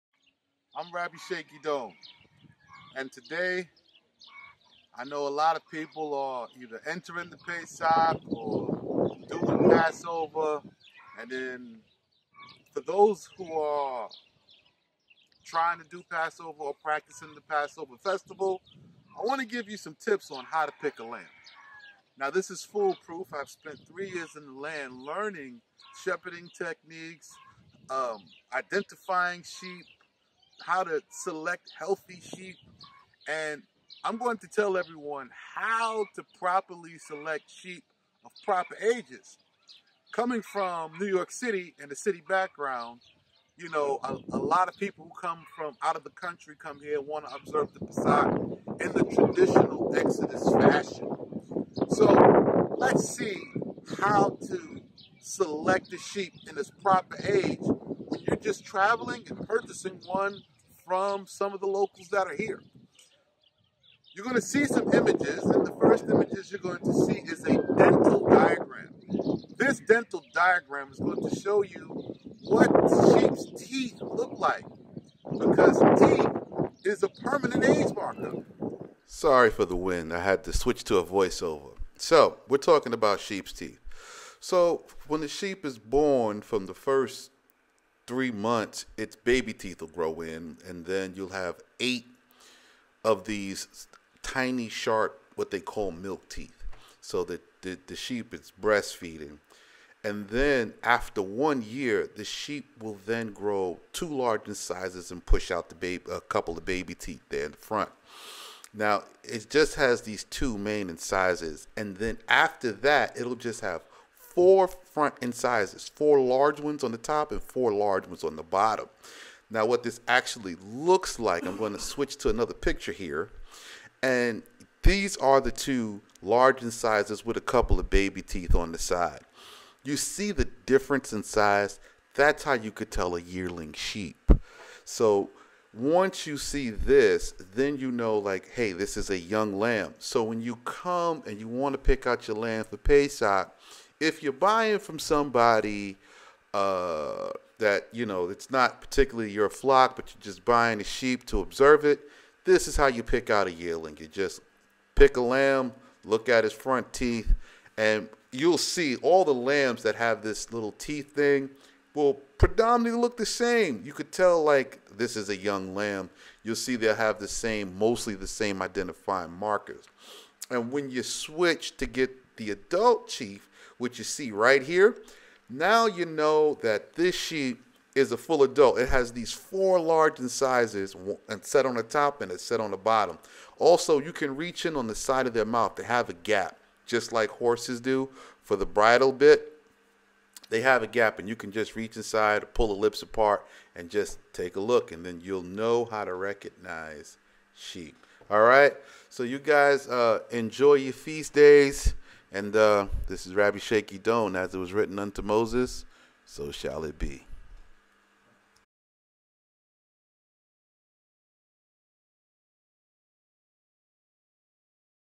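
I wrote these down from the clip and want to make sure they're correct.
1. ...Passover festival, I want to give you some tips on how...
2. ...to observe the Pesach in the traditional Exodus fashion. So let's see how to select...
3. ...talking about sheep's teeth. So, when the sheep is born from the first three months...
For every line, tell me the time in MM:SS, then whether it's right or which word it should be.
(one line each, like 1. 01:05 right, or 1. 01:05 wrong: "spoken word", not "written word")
1. 00:17 right
2. 00:47 right
3. 01:22 right.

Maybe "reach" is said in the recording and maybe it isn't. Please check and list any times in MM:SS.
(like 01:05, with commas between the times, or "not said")
03:04, 03:11.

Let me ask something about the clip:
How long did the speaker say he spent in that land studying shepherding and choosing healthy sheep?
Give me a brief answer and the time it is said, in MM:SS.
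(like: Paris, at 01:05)
3 years, at 00:23.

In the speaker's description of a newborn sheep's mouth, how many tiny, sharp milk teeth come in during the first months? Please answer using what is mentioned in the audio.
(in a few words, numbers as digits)
8.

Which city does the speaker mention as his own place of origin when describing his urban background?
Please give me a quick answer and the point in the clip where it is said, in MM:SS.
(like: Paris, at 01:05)
New York City, at 00:40.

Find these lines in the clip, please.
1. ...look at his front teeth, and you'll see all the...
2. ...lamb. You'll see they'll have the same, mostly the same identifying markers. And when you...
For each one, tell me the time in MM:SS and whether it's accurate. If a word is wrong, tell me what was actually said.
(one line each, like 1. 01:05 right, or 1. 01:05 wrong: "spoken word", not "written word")
1. 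02:36 right
2. 02:45 right.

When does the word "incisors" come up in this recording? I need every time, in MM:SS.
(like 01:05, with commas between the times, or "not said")
01:44, 01:50, 01:55, 02:06, 03:00.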